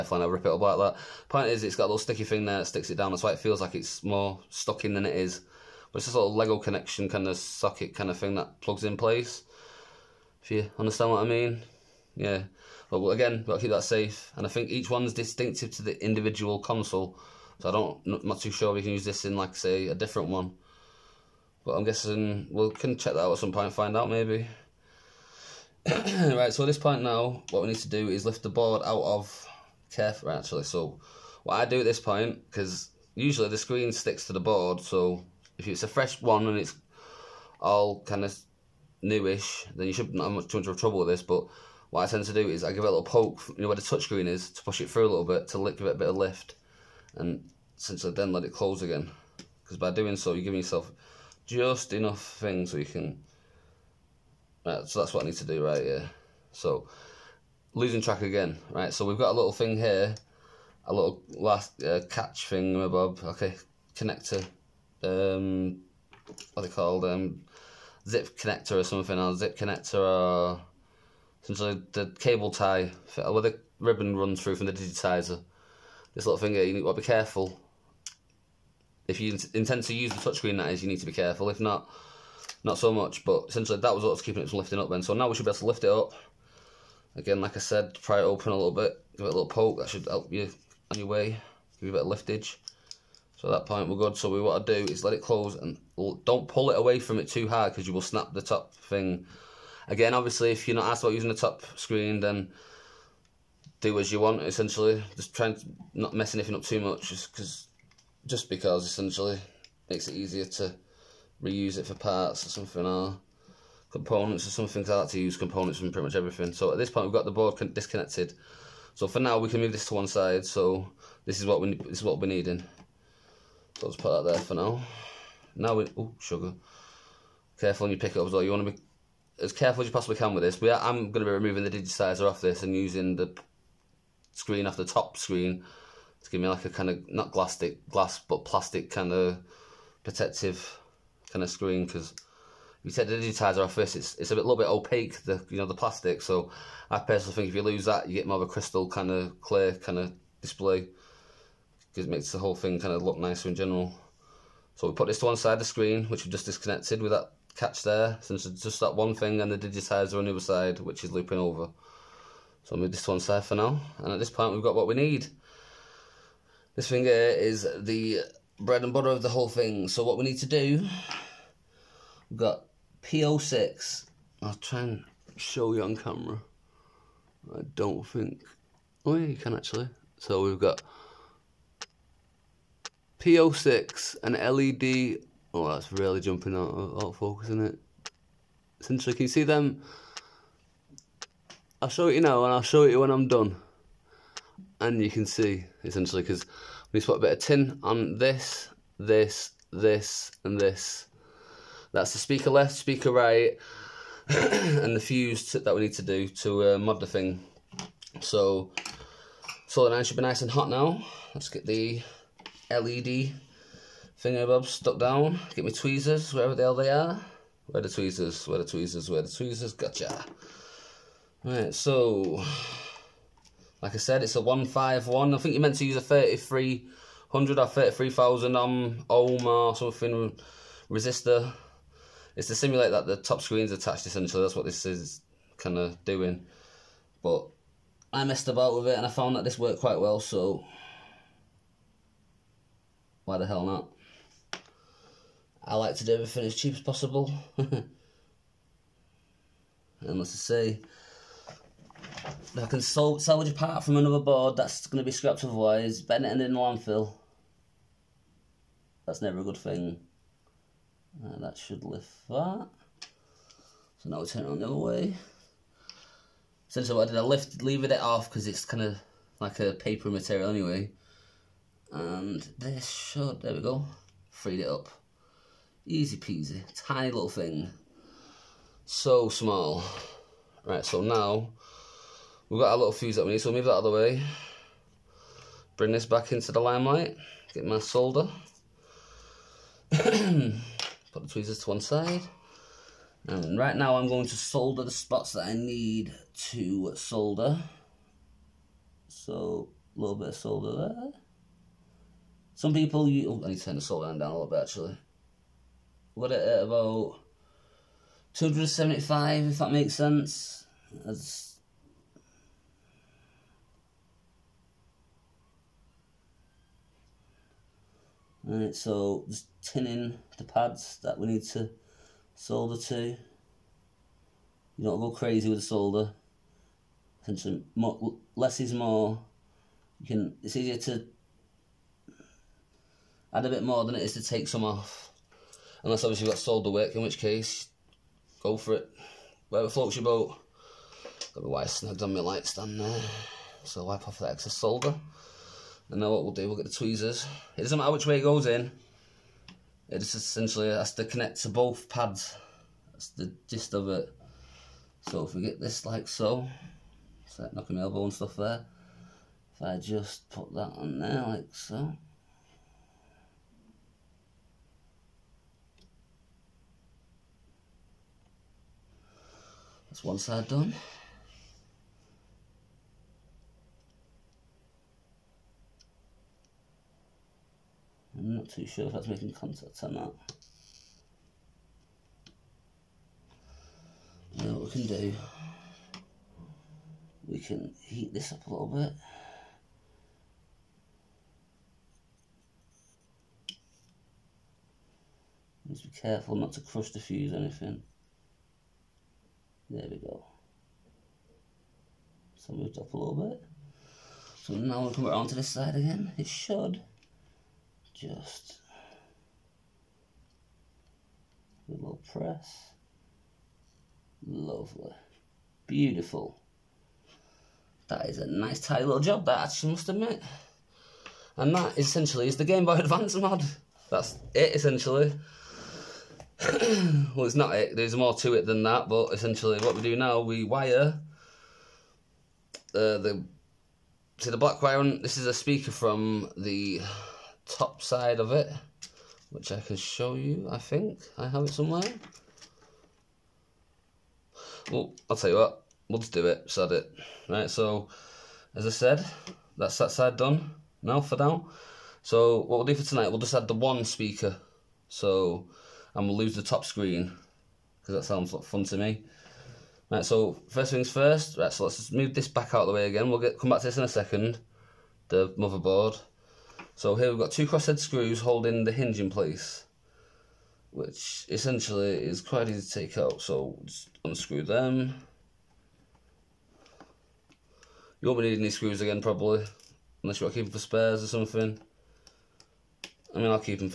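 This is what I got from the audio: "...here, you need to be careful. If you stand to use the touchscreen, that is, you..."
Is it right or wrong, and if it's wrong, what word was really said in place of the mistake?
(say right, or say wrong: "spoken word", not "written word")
wrong: "intend", not "stand".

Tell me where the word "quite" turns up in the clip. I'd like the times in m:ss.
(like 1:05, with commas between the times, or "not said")
3:59, 7:52.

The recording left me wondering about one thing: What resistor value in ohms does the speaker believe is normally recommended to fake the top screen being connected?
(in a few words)
33,000.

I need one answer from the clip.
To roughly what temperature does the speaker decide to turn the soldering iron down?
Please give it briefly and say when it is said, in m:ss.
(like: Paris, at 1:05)
275, at 5:08.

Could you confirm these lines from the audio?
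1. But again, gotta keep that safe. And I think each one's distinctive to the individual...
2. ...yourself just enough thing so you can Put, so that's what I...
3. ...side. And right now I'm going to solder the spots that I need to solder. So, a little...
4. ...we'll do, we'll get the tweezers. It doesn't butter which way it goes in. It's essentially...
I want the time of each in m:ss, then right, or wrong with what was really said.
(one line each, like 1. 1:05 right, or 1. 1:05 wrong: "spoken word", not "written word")
1. 0:12 right
2. 0:50 wrong: "Right", not "Put"
3. 4:51 right
4. 5:46 wrong: "matter", not "butter".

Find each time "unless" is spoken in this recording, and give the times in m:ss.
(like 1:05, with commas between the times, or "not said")
5:35, 8:00.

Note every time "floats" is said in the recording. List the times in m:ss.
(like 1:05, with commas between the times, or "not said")
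5:39.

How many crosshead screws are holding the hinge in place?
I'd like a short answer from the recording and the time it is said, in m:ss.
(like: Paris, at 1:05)
2, at 7:47.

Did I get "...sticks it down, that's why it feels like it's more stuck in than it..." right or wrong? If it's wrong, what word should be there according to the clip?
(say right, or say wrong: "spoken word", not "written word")
right.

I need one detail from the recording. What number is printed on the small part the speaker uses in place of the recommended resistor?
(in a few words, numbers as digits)
151.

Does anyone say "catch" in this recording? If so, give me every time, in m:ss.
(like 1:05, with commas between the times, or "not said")
1:02, 2:37.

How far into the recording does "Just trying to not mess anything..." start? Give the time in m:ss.
1:45.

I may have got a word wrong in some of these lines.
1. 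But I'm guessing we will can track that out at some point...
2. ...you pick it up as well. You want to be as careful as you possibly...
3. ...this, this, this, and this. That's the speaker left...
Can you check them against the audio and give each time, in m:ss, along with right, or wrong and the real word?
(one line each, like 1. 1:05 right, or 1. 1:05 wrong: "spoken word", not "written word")
1. 0:21 wrong: "check", not "track"
2. 2:07 right
3. 3:18 right.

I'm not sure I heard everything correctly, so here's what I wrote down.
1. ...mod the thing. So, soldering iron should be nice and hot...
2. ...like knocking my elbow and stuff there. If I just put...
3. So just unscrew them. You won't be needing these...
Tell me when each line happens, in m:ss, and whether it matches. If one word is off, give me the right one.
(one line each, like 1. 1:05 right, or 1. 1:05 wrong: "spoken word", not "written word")
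1. 3:26 right
2. 5:57 right
3. 7:53 right.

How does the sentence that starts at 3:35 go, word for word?
Get my tweezers, wherever the hell they are.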